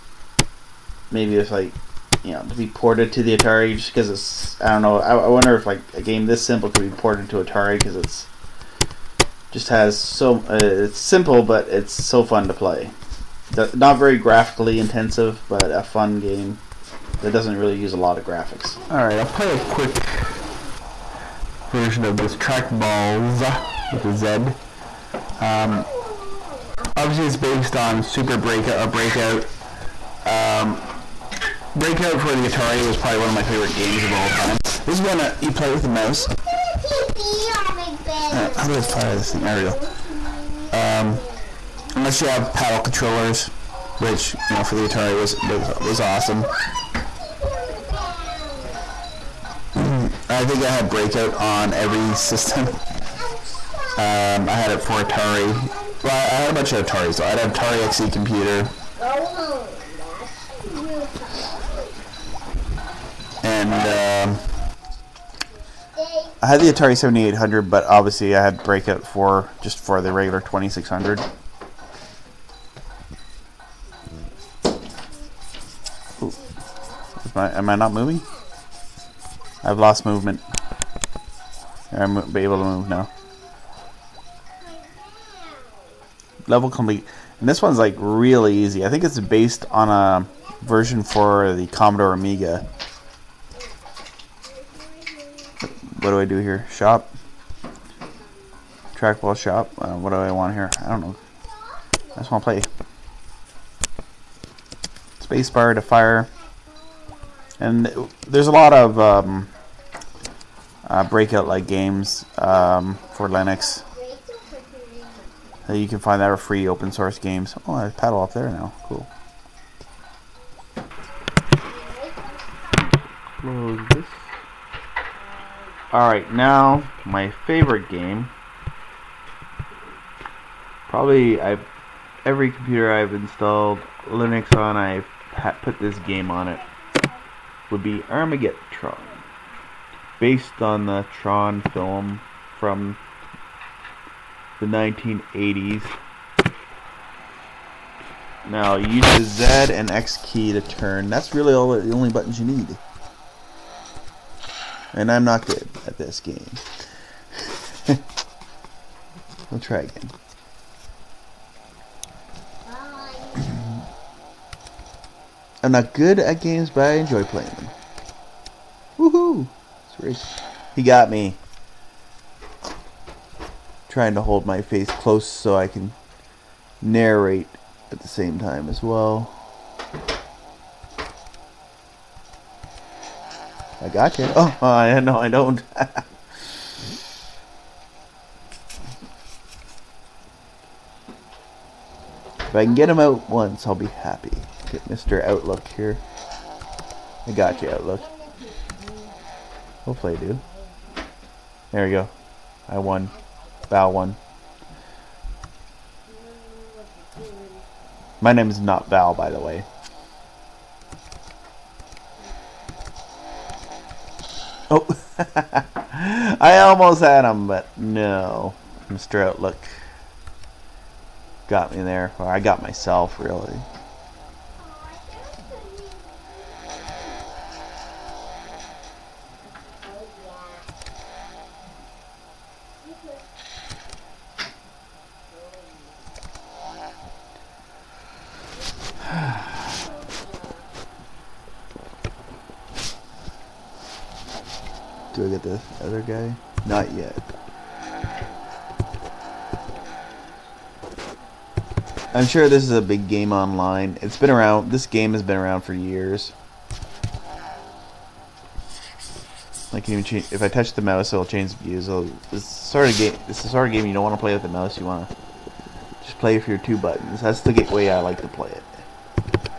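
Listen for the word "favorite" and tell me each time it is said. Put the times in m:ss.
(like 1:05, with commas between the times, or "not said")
0:33, 2:07.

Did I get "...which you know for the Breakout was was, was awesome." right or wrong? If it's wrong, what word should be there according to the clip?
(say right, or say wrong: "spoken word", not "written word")
wrong: "Atari", not "Breakout".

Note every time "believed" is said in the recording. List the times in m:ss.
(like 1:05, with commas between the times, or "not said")
not said.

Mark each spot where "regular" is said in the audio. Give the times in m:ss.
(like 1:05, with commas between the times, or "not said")
1:10.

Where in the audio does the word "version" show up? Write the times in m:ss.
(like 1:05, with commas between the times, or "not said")
0:21, 1:30.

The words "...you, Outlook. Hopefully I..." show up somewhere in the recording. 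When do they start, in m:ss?
3:17.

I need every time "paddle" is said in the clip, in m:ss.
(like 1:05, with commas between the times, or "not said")
0:42, 1:57.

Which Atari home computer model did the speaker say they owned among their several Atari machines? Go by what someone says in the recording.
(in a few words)
Atari XE.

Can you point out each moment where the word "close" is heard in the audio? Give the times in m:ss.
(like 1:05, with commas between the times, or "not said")
2:03, 2:54.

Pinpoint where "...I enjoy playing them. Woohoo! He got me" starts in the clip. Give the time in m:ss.
2:46.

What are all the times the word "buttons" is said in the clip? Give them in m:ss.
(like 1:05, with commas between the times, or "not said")
2:32, 4:26.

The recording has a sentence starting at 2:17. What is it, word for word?
Would be Armagetron, based on the Tron film from the 1980s.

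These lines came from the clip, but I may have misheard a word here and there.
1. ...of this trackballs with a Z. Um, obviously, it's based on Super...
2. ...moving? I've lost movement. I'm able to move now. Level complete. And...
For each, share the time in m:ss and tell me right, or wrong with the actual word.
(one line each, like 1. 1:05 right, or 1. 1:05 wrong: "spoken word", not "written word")
1. 0:22 right
2. 1:17 right.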